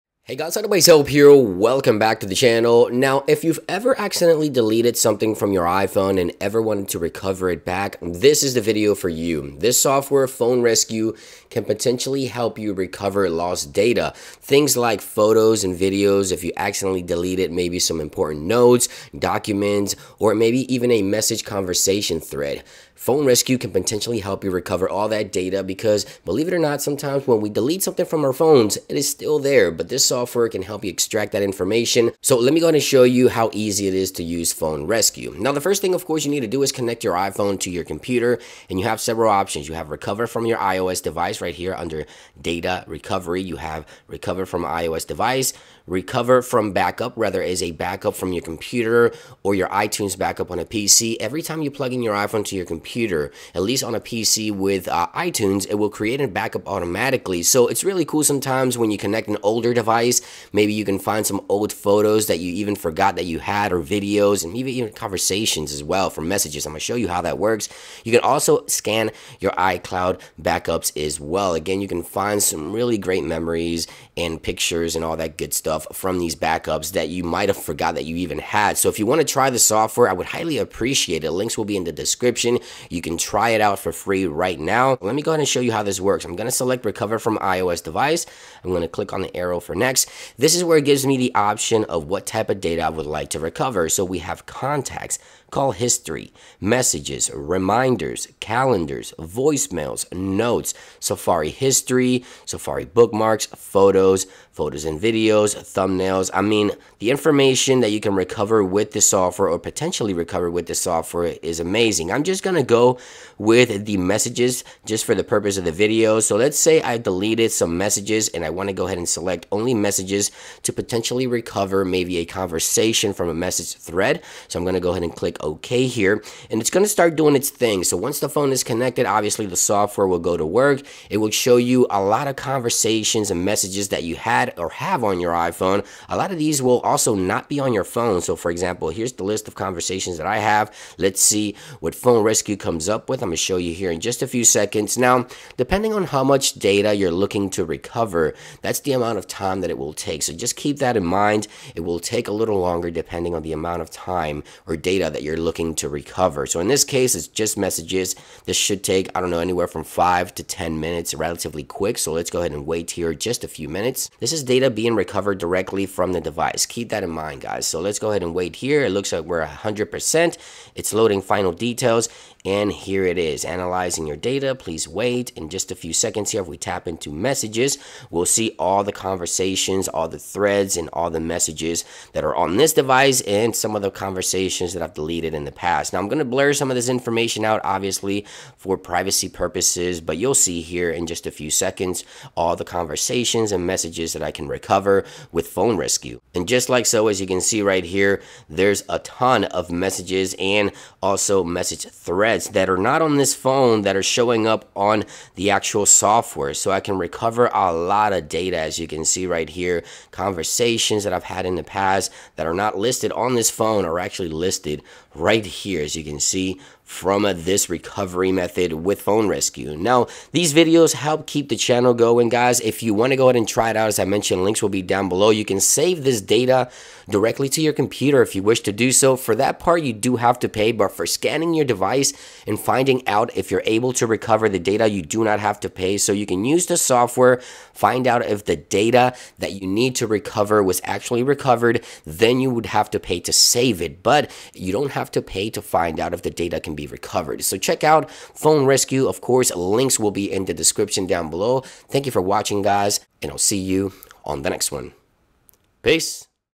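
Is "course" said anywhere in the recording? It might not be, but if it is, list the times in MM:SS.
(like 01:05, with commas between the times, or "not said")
00:36, 04:09.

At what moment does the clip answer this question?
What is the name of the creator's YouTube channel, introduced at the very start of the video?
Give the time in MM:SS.
00:00.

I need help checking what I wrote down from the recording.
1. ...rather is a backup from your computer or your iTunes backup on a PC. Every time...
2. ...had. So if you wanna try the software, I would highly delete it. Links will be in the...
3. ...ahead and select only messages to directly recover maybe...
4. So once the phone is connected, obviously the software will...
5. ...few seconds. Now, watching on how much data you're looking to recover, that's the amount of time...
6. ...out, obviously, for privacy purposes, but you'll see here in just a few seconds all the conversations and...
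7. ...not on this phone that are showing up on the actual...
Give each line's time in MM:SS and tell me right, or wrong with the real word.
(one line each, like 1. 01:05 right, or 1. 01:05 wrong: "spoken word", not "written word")
1. 00:47 right
2. 01:18 wrong: "appreciate", not "delete"
3. 01:58 wrong: "potentially", not "directly"
4. 02:07 right
5. 02:24 wrong: "depending", not "watching"
6. 03:07 right
7. 03:22 right.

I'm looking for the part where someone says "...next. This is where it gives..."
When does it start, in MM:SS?
01:29.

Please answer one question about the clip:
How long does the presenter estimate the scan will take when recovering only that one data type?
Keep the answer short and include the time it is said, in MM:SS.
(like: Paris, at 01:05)
5 to 10 minutes, at 02:39.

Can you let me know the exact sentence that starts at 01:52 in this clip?
I'm just going to go with the messages just for the purpose of the video.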